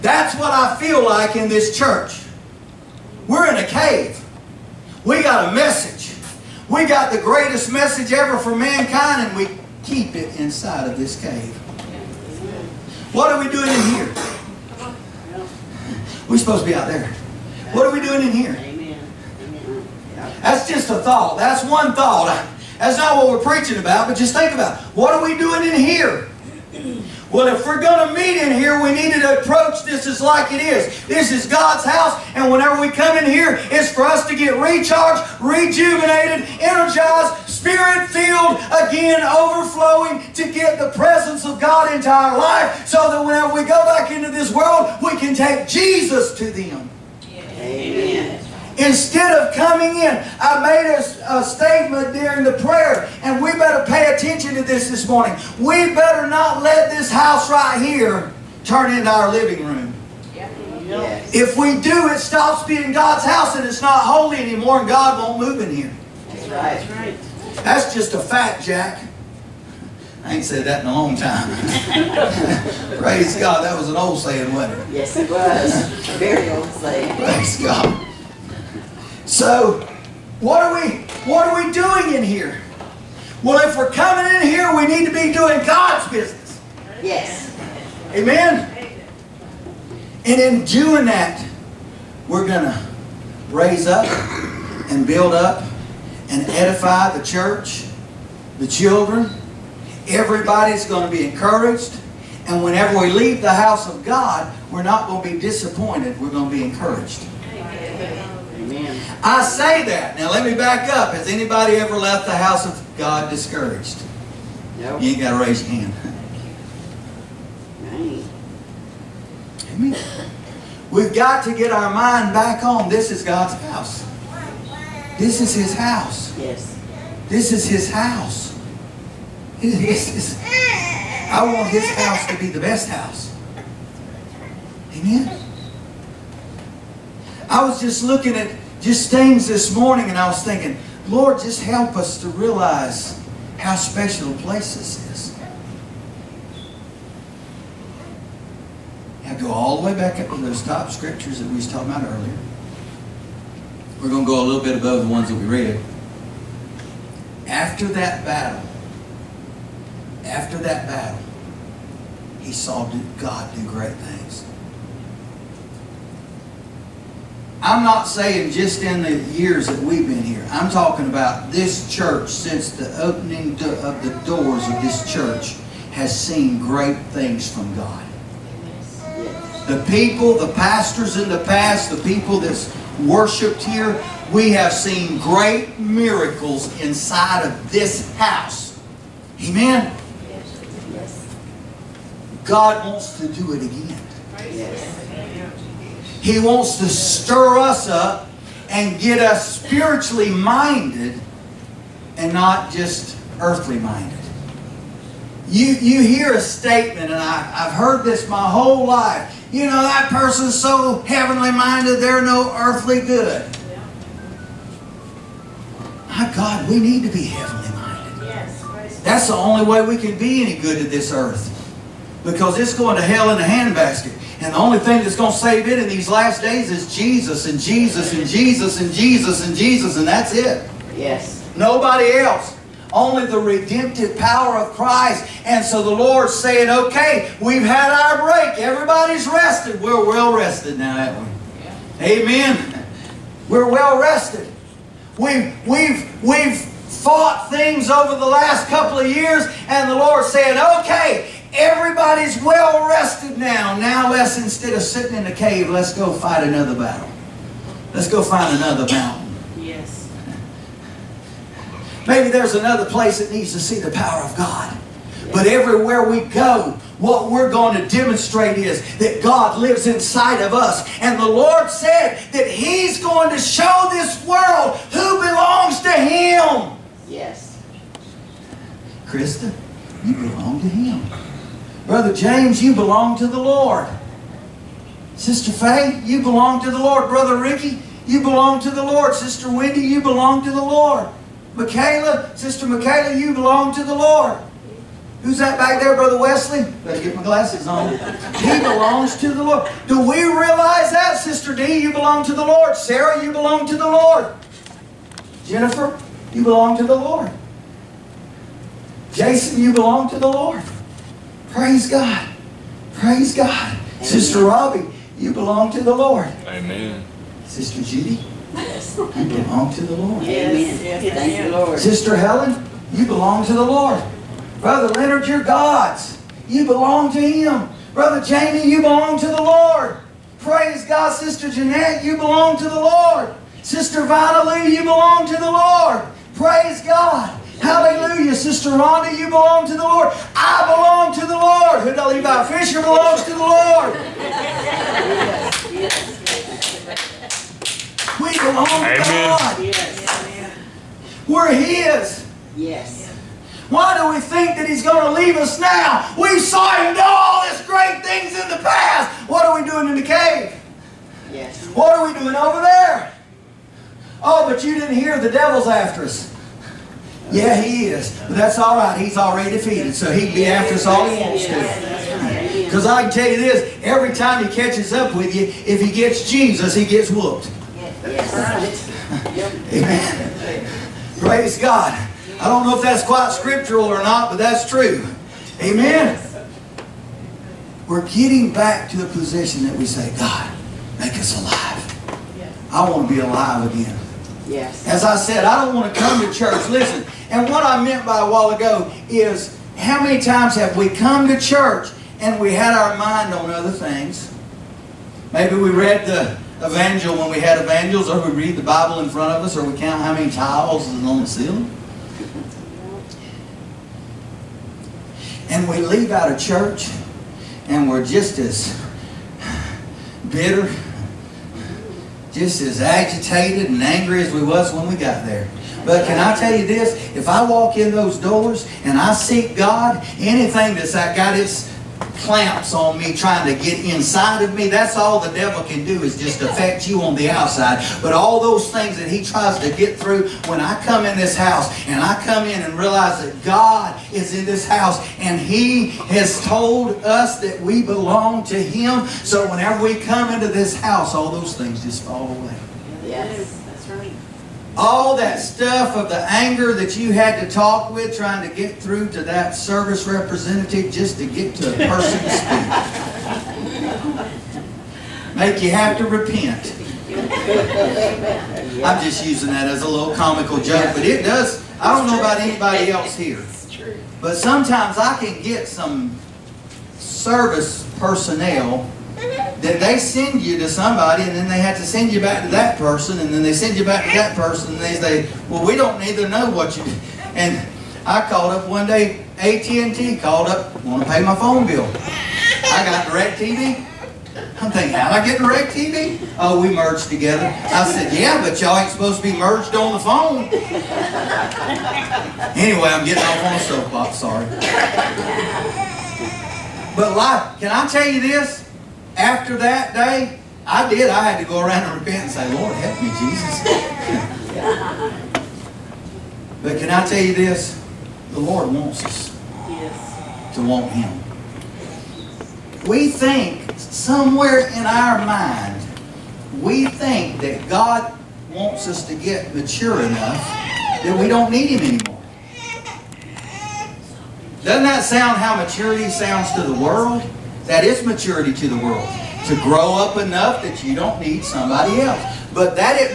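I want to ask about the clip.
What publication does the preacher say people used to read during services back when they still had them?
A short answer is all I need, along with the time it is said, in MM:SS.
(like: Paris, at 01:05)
The Evangel, at 06:46.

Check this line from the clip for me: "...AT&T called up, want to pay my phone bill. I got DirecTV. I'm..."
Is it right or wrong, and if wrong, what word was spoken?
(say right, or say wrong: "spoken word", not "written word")
right.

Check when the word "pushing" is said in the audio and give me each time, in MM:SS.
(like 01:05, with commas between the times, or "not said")
not said.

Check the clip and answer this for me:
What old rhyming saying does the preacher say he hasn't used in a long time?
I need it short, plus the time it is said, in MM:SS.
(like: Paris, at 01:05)
That's just a fact, Jack, at 01:07.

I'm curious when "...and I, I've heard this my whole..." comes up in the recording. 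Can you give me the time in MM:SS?
03:27.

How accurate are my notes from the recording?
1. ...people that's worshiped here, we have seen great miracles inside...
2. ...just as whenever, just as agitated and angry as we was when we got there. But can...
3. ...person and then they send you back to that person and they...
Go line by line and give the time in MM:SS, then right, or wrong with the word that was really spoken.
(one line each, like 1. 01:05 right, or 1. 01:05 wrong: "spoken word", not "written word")
1. 03:02 right
2. 06:58 wrong: "bitter", not "whenever"
3. 08:02 right.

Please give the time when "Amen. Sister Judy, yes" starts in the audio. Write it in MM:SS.
05:16.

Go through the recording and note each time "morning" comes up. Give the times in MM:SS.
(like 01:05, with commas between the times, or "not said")
00:55, 02:19.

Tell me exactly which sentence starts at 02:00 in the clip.
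We've got to get our mind back on this is God's house.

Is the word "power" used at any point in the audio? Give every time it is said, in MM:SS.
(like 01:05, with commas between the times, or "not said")
03:54, 04:23.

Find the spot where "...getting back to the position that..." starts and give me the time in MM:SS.
06:28.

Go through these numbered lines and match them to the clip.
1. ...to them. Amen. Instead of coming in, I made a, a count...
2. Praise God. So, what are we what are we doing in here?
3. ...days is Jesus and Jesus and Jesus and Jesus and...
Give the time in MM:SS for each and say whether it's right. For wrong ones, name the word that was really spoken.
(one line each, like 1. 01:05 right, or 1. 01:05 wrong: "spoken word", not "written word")
1. 00:46 wrong: "statement", not "count"
2. 01:17 right
3. 03:46 right.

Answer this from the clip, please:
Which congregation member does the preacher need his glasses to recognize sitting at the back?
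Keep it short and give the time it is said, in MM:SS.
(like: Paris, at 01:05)
Brother Wesley, at 04:55.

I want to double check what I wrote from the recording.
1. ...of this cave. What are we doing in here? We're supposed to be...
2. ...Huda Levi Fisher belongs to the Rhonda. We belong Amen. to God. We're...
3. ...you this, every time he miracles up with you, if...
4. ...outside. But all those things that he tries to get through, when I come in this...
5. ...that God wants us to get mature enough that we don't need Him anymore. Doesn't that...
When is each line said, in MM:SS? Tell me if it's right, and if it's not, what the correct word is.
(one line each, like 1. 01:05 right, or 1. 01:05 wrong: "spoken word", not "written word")
1. 00:10 right
2. 05:41 wrong: "Lord", not "Rhonda"
3. 06:13 wrong: "catches", not "miracles"
4. 07:17 right
5. 08:47 right.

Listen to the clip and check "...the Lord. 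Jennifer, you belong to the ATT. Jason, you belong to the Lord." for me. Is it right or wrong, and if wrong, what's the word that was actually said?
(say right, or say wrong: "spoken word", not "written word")
wrong: "Lord", not "ATT".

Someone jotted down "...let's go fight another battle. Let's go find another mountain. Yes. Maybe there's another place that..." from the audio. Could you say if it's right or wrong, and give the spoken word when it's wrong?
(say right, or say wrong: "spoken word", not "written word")
right.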